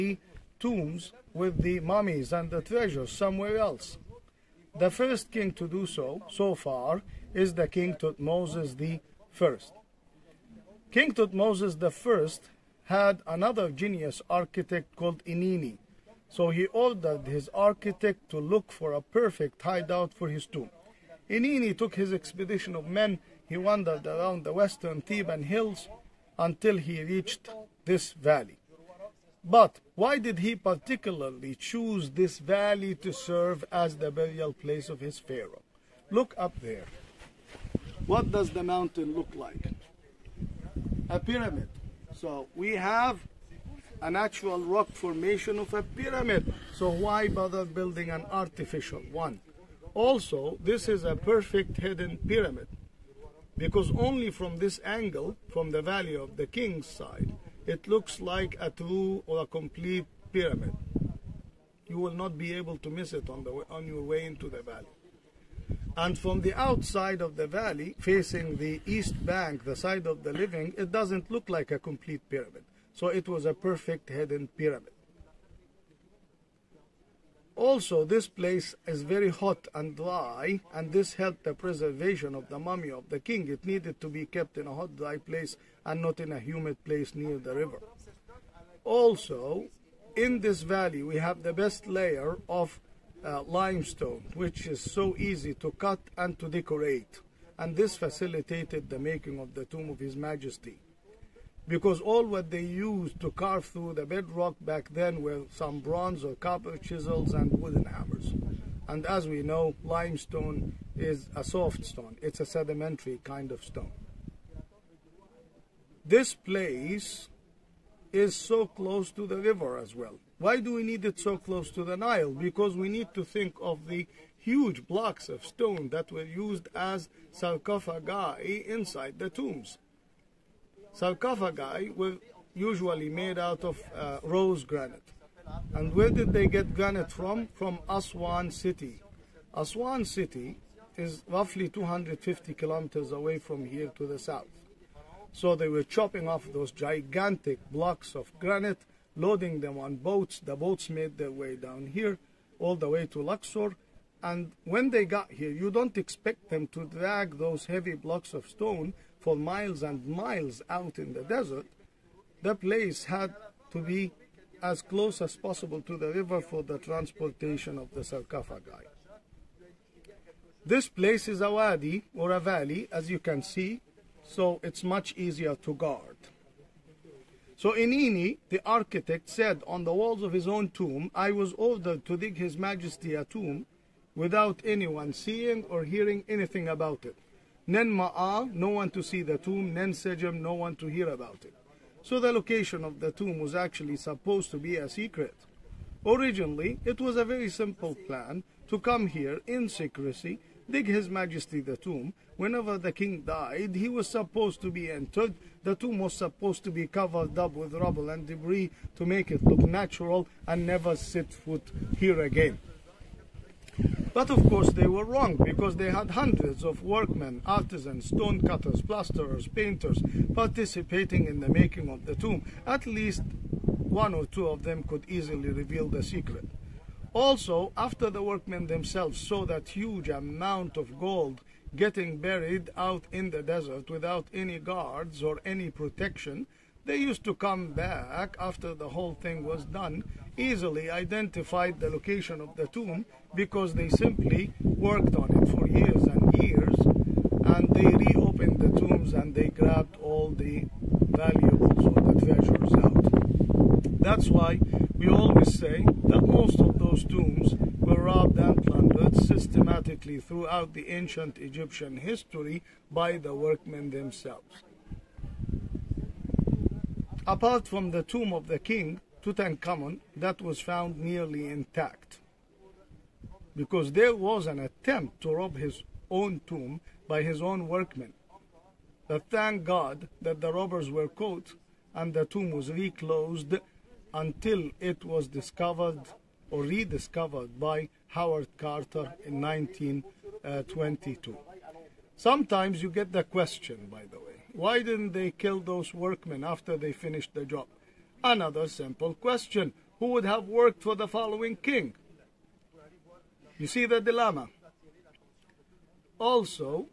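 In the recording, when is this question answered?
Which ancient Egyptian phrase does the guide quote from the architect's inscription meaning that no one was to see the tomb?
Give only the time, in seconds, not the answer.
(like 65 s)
187 s.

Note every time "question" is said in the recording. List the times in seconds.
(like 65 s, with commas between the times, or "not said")
293 s, 299 s.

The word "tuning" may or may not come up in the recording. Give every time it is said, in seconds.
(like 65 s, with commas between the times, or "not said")
not said.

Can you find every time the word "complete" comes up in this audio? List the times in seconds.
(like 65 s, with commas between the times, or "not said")
59 s, 71 s.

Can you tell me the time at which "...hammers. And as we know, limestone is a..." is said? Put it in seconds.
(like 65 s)
107 s.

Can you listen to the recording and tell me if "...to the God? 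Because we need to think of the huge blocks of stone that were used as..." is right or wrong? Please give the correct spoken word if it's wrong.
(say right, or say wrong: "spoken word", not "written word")
wrong: "Nile", not "God".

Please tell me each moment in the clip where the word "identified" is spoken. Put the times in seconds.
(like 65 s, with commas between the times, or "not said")
240 s.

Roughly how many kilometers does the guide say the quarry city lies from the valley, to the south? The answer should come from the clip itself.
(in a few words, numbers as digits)
250 kilometers.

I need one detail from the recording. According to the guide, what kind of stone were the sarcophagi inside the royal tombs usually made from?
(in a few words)
rose granite.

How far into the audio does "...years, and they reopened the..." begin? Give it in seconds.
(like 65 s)
246 s.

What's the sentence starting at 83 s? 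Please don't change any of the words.
It needed to be kept in a hot, dry place and not in a humid place near the river.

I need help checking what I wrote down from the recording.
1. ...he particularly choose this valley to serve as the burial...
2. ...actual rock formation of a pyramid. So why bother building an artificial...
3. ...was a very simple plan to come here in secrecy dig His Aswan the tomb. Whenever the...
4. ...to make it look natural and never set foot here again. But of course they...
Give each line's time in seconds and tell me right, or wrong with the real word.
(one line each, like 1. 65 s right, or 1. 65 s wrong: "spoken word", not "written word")
1. 30 s right
2. 44 s right
3. 196 s wrong: "Majesty", not "Aswan"
4. 208 s right.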